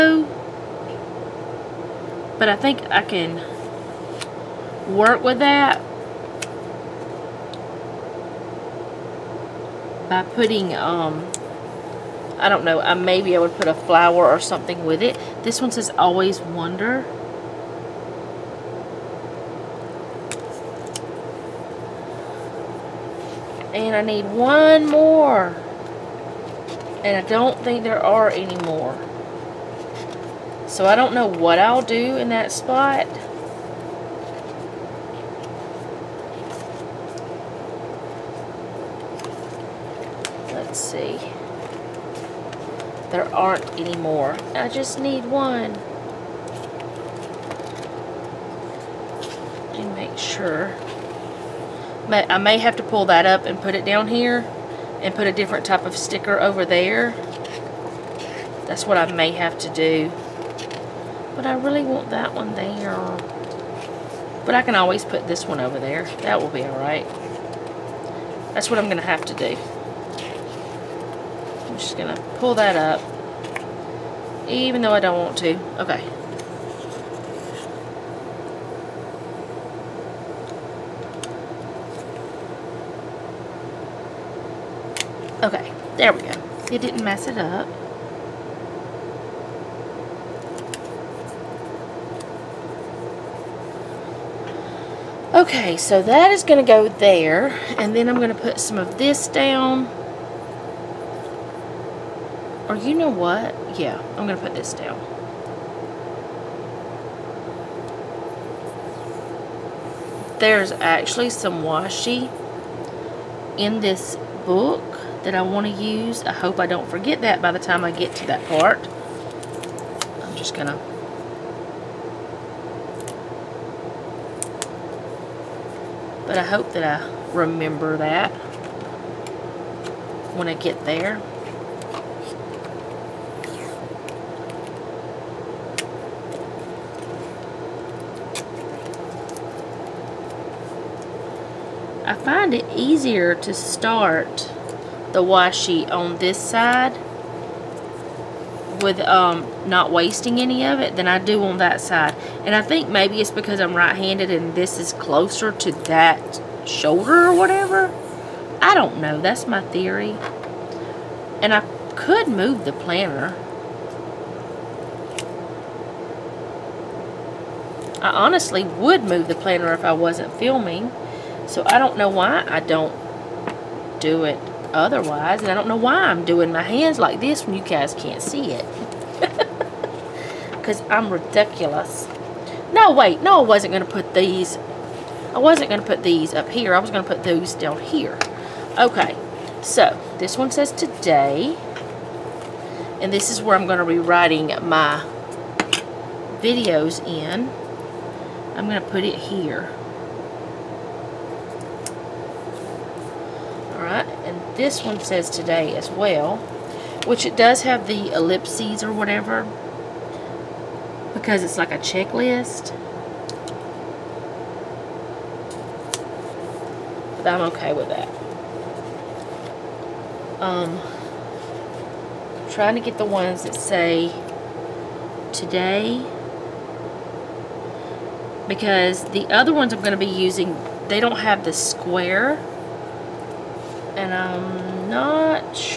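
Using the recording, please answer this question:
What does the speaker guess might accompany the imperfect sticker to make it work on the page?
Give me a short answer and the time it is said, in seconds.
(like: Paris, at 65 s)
a flower, at 13 s.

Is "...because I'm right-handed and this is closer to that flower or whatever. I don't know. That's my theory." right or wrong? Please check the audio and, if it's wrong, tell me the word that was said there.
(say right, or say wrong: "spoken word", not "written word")
wrong: "shoulder", not "flower".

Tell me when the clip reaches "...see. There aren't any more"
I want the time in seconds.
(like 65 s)
40 s.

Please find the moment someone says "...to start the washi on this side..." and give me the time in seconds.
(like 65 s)
143 s.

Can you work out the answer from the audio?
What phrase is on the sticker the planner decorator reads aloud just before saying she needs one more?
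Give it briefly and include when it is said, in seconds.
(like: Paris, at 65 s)
Always Wonder, at 15 s.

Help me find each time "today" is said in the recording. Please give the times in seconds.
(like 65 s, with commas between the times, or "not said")
190 s, 205 s, 225 s.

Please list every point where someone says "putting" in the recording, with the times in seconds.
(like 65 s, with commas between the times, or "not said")
10 s.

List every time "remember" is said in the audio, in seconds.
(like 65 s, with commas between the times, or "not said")
127 s.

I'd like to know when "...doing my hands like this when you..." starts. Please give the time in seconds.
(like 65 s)
176 s.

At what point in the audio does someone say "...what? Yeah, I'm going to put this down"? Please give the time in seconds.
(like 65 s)
103 s.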